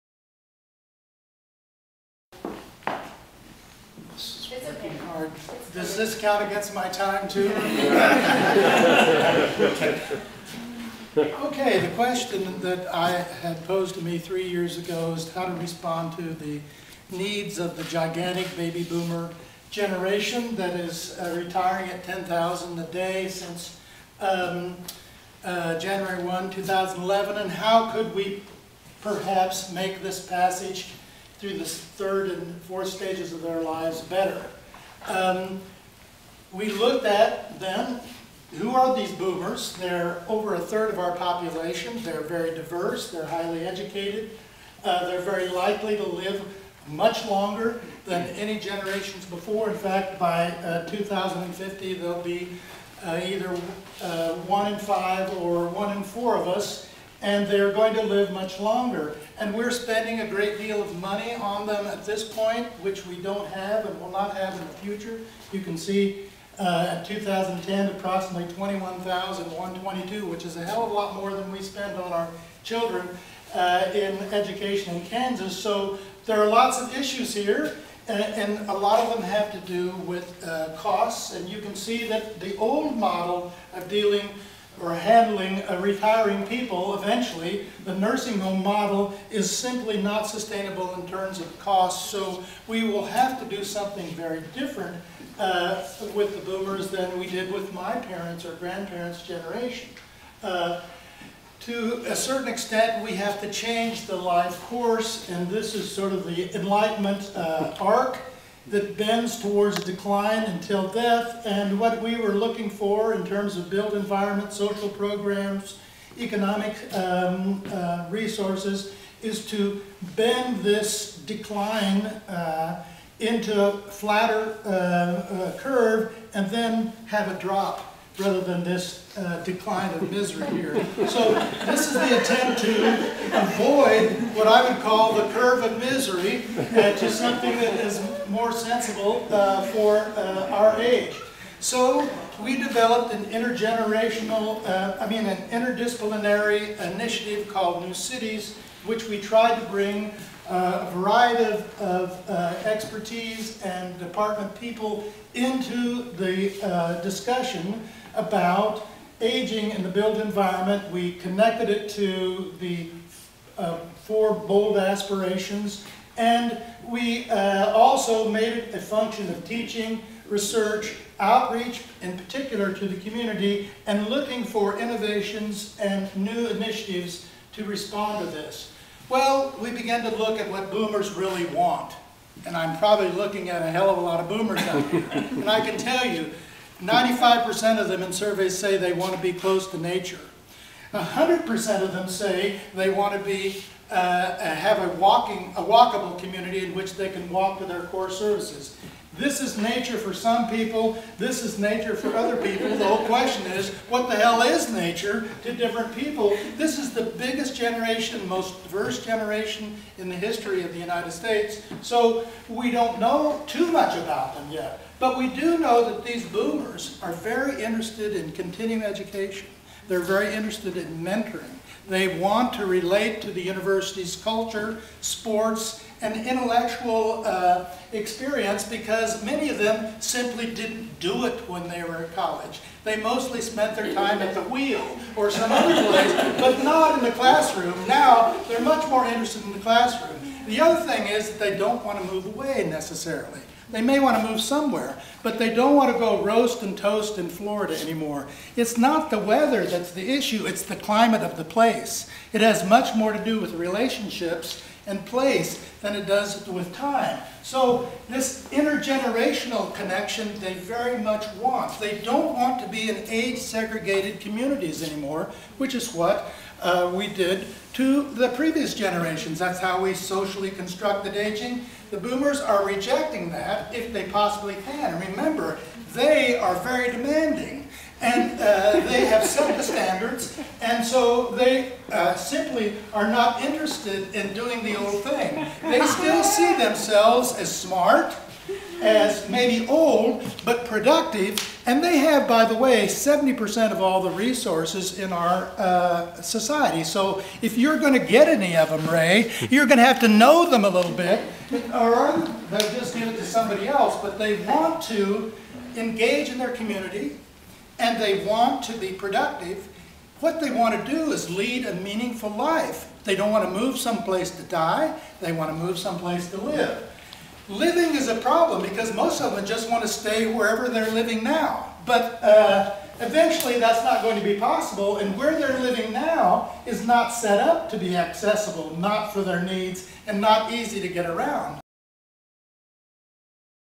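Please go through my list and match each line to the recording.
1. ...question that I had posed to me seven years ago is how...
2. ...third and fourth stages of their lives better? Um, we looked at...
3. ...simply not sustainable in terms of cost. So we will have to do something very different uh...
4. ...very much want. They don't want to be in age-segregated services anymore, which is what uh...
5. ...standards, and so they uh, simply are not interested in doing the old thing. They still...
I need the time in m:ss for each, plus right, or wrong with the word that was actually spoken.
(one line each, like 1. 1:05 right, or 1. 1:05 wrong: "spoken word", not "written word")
1. 0:11 wrong: "three", not "seven"
2. 0:31 right
3. 1:29 right
4. 4:20 wrong: "communities", not "services"
5. 4:39 right.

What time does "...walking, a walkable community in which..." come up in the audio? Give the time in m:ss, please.
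3:14.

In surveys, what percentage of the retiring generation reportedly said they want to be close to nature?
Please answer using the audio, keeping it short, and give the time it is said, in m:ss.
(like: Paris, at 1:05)
95%, at 3:06.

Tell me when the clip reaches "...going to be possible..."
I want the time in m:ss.
5:24.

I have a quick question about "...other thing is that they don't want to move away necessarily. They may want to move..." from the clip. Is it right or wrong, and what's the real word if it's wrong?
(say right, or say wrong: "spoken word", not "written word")
right.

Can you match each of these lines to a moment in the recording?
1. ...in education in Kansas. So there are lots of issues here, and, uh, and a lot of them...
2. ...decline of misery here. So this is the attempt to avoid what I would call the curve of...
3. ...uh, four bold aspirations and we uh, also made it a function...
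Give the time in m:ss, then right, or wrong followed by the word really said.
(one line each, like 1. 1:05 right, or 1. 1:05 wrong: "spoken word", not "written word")
1. 1:13 right
2. 2:09 right
3. 2:43 right.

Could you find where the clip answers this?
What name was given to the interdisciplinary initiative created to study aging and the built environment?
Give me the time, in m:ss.
2:27.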